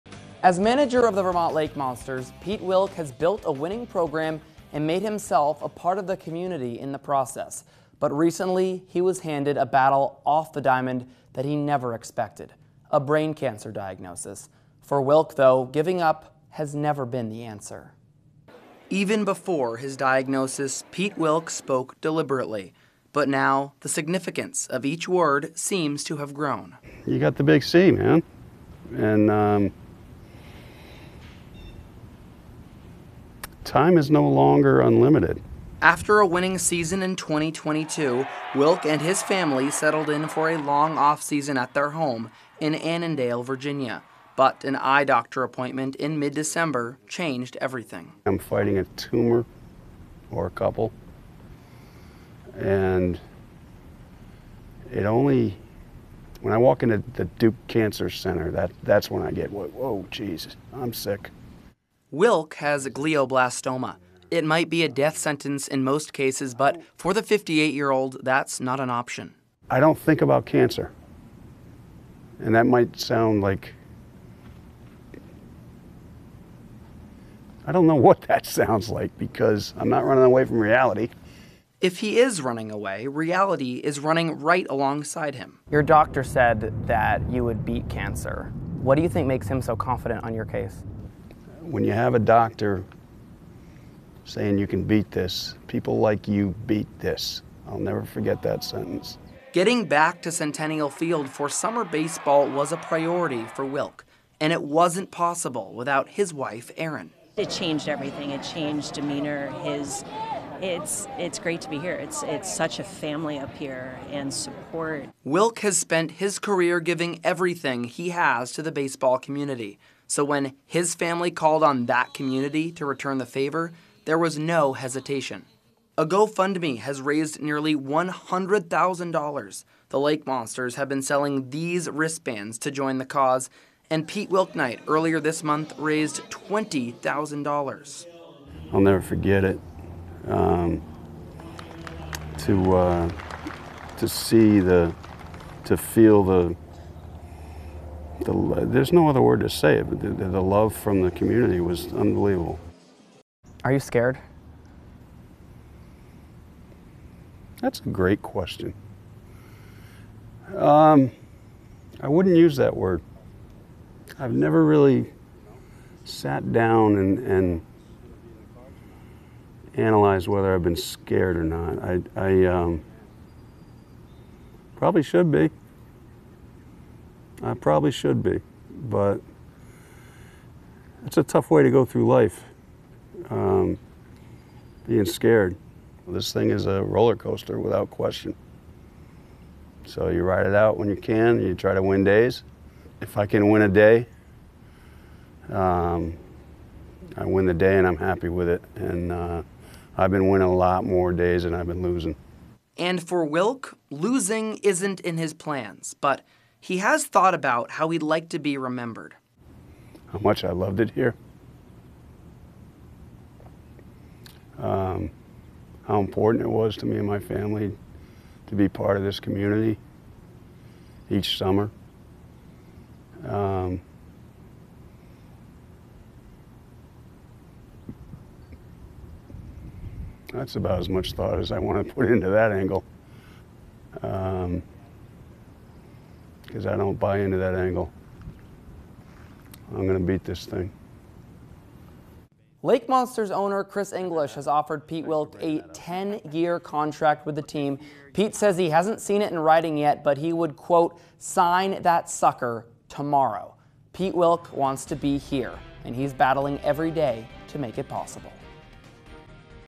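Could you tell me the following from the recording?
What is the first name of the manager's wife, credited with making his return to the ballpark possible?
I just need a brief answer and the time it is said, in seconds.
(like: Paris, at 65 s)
Erin, at 106 s.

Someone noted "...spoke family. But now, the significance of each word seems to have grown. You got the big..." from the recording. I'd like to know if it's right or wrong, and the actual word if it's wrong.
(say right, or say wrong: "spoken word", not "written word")
wrong: "deliberately", not "family".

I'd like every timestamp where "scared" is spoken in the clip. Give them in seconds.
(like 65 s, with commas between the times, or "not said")
153 s, 170 s, 185 s.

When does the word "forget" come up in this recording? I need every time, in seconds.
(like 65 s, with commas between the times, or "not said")
98 s, 138 s.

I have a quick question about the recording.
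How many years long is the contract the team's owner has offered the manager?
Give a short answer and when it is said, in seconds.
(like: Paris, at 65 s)
10, at 245 s.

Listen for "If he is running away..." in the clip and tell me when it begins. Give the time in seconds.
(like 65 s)
81 s.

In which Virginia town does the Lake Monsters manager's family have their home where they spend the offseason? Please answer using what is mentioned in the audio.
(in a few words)
Annandale.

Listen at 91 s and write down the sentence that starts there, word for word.
when you have a doctor saying you can beat this, people like you beat this.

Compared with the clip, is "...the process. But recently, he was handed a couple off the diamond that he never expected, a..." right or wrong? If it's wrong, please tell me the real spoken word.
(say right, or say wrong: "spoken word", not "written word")
wrong: "battle", not "couple".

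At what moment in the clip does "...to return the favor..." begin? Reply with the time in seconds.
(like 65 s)
122 s.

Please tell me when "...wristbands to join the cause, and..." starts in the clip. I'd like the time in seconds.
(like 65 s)
131 s.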